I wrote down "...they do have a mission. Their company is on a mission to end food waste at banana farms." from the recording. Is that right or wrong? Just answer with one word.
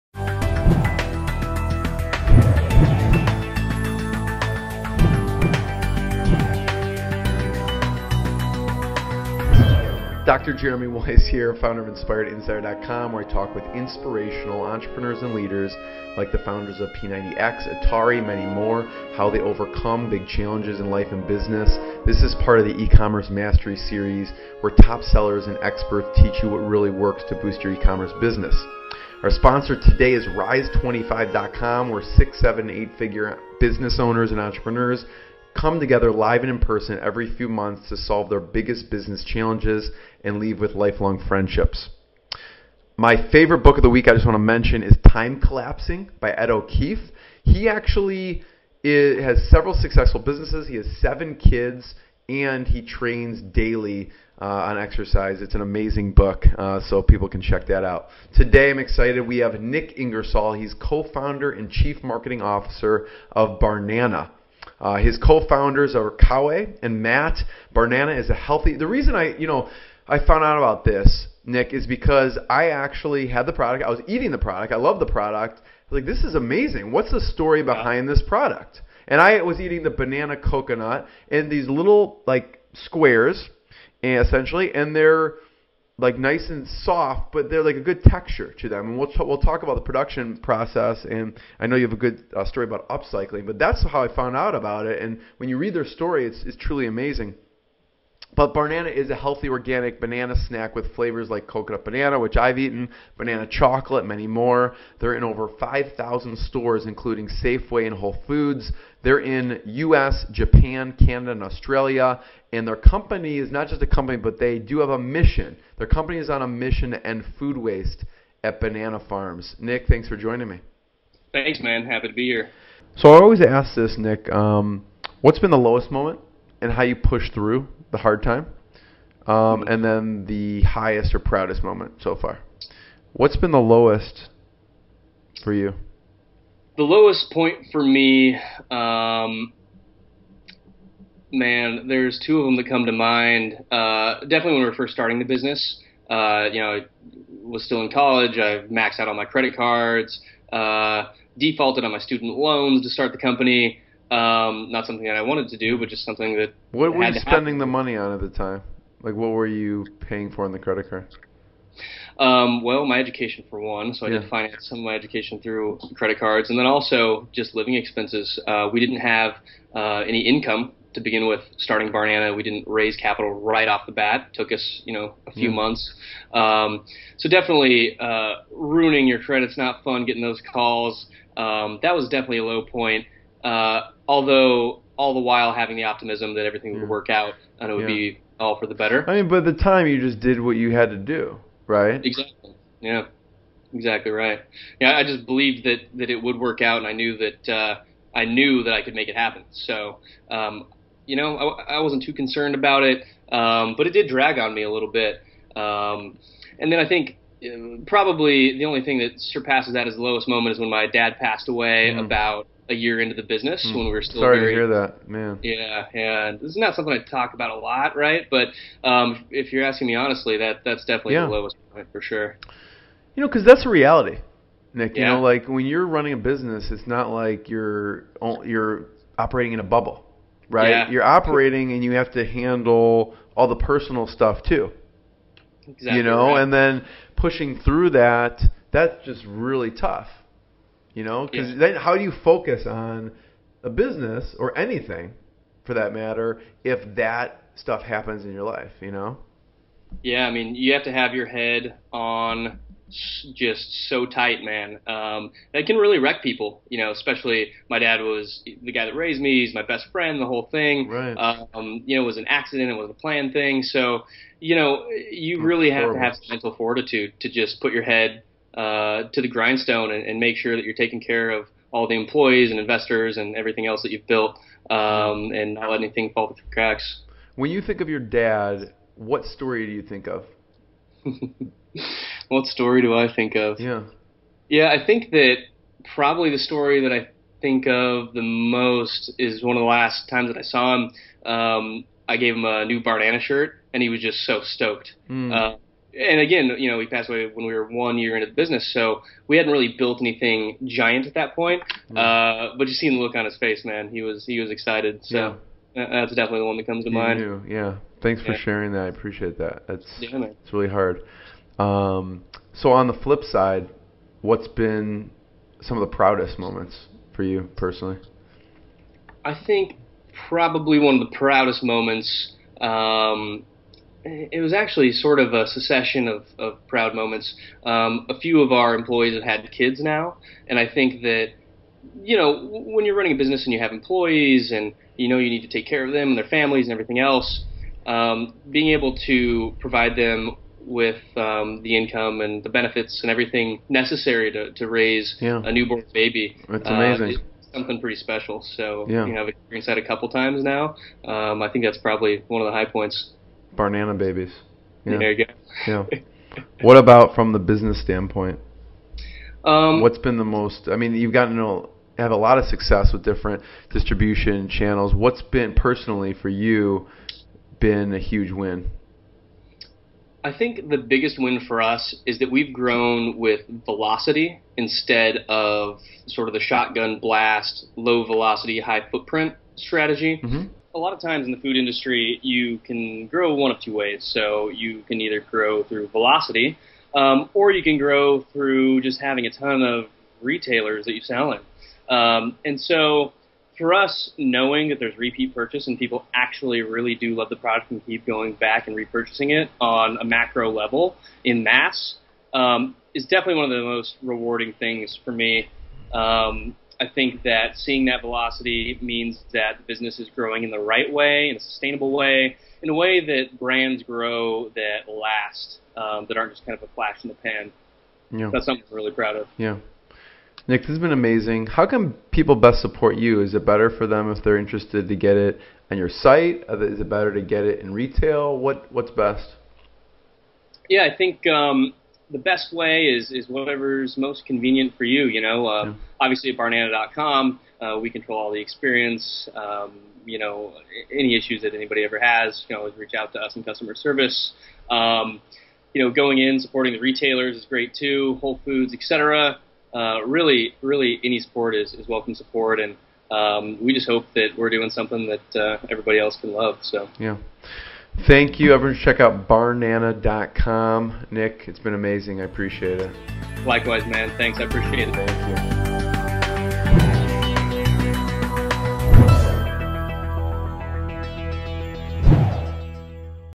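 right.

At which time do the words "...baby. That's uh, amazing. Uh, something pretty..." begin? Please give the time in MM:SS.
05:45.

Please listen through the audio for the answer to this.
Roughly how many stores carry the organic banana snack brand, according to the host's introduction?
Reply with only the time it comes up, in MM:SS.
01:45.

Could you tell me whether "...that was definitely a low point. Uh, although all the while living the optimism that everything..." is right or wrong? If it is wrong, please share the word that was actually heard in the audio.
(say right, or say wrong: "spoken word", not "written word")
wrong: "having", not "living".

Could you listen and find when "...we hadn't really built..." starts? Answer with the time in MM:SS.
04:59.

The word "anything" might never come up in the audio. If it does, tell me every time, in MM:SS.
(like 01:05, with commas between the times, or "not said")
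04:04, 04:35, 05:00.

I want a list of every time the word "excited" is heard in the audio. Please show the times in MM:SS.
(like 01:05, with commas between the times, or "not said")
00:58, 05:04.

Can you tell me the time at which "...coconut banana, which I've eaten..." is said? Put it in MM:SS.
01:41.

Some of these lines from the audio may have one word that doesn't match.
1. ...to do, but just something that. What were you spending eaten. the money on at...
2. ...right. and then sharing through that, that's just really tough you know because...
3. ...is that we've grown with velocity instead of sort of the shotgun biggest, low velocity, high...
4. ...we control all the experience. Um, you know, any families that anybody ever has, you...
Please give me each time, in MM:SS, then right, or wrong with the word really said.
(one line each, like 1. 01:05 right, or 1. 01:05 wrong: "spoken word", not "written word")
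1. 02:35 wrong: "happen", not "eaten"
2. 03:56 wrong: "pushing", not "sharing"
3. 06:12 wrong: "blast", not "biggest"
4. 07:17 wrong: "issues", not "families".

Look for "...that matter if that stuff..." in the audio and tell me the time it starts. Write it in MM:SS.
04:05.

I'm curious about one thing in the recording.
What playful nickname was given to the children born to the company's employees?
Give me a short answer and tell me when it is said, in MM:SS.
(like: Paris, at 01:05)
banana babies, at 05:53.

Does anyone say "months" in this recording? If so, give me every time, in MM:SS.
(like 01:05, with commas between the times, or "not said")
00:37, 02:55.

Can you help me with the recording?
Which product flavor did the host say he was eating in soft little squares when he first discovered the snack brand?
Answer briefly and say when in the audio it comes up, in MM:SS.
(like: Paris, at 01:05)
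banana coconut, at 01:19.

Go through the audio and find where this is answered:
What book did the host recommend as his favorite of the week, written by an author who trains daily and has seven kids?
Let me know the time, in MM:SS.
00:45.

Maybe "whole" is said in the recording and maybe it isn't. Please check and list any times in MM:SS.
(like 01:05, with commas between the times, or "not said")
01:47, 04:20, 07:28.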